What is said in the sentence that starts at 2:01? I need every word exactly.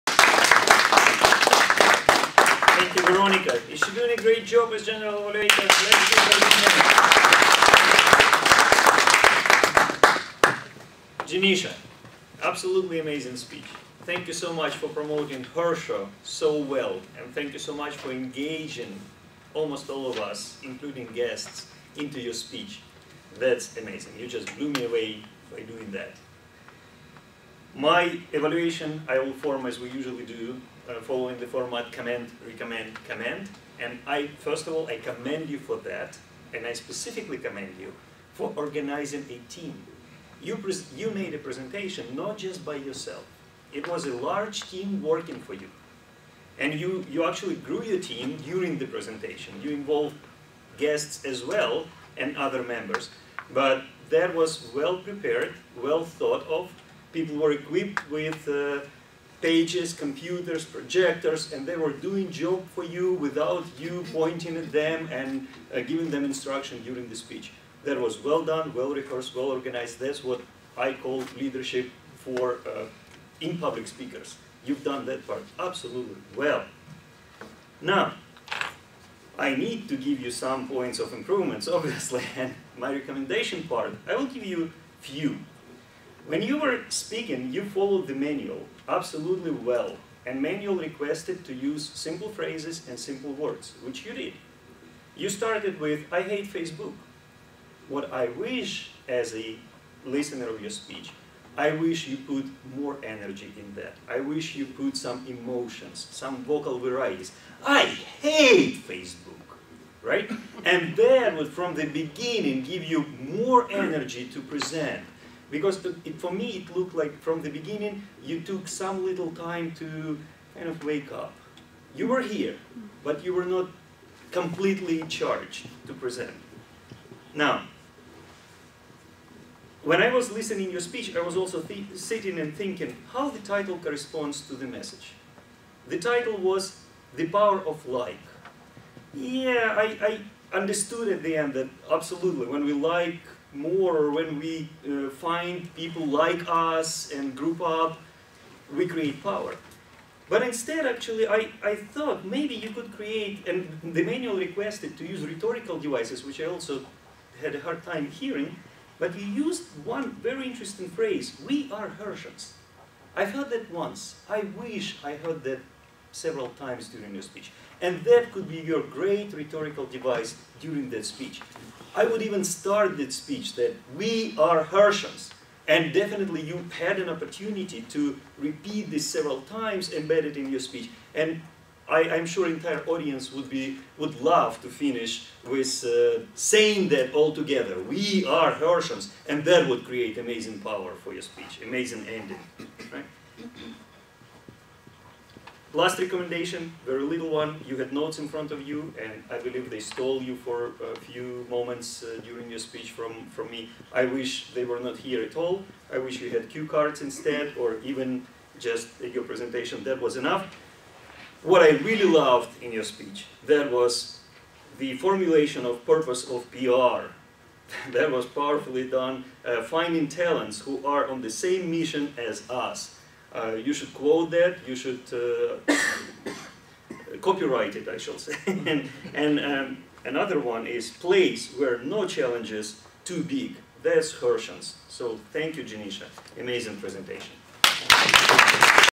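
You were here, but you were not completely charged to present.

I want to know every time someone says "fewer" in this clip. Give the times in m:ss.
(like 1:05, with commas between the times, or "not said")
not said.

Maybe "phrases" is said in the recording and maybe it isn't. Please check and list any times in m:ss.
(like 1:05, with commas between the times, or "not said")
1:32, 2:40.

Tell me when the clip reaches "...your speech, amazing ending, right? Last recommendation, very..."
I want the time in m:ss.
3:11.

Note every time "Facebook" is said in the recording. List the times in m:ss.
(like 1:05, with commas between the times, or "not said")
1:36, 1:48.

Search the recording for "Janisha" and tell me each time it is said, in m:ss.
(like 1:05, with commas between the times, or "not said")
0:11, 3:55.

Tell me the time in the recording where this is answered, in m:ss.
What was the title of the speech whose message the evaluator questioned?
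2:17.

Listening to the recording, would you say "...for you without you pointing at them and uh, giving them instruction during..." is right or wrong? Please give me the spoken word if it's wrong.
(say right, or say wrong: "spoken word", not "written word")
right.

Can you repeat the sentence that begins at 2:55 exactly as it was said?
And definitely you had an opportunity to repeat this several times, embedded in your speech.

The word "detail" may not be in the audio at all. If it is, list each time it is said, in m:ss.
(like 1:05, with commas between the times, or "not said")
not said.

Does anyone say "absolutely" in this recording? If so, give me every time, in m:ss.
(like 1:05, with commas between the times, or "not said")
0:12, 1:15, 1:28, 2:21.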